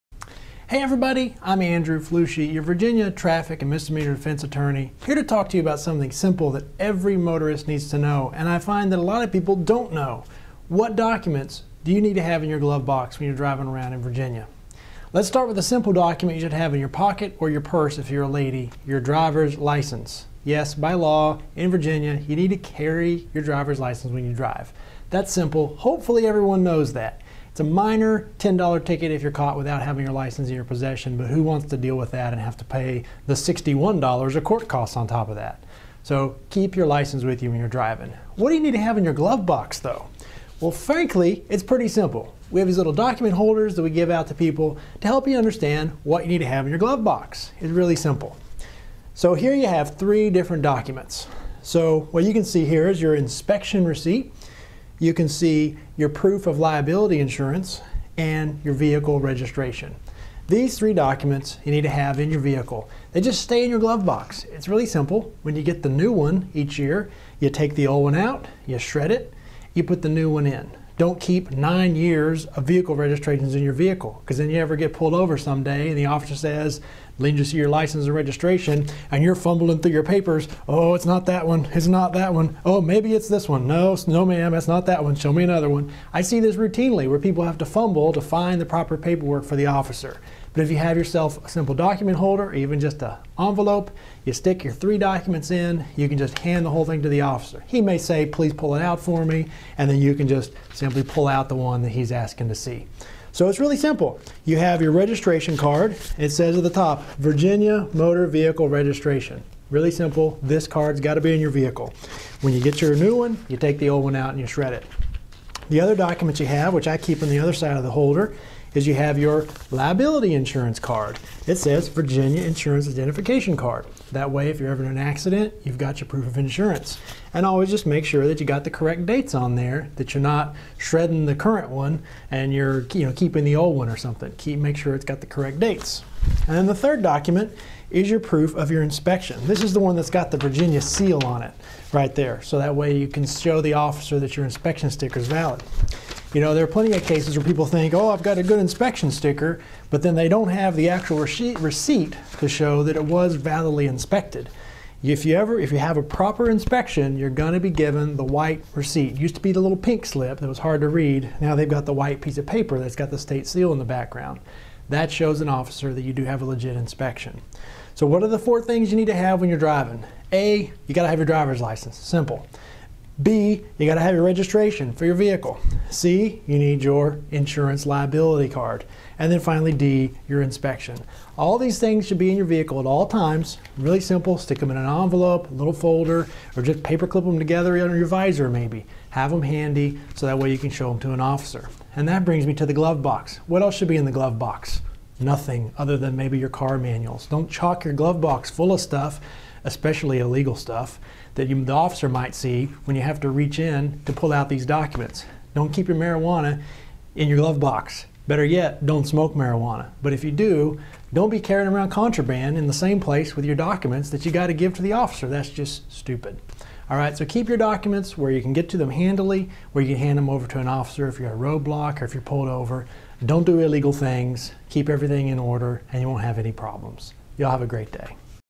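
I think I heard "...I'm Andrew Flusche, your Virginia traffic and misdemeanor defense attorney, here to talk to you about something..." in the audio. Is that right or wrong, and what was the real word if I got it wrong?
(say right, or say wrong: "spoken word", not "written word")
right.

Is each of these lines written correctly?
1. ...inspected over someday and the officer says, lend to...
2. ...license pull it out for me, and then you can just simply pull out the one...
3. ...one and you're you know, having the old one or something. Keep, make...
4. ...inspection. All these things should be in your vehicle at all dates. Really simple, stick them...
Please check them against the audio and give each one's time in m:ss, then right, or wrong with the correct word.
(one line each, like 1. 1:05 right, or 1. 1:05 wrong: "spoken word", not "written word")
1. 1:14 wrong: "pulled", not "inspected"
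2. 1:38 wrong: "please", not "license"
3. 2:11 wrong: "keeping", not "having"
4. 3:00 wrong: "times", not "dates".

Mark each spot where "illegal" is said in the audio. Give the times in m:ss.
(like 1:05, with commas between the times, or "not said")
3:20, 3:43.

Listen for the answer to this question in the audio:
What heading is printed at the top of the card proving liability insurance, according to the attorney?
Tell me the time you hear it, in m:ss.
2:01.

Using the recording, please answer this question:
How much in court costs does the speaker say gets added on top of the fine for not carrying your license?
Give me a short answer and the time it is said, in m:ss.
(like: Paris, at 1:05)
$61, at 0:33.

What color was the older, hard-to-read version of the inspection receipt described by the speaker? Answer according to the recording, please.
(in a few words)
pink.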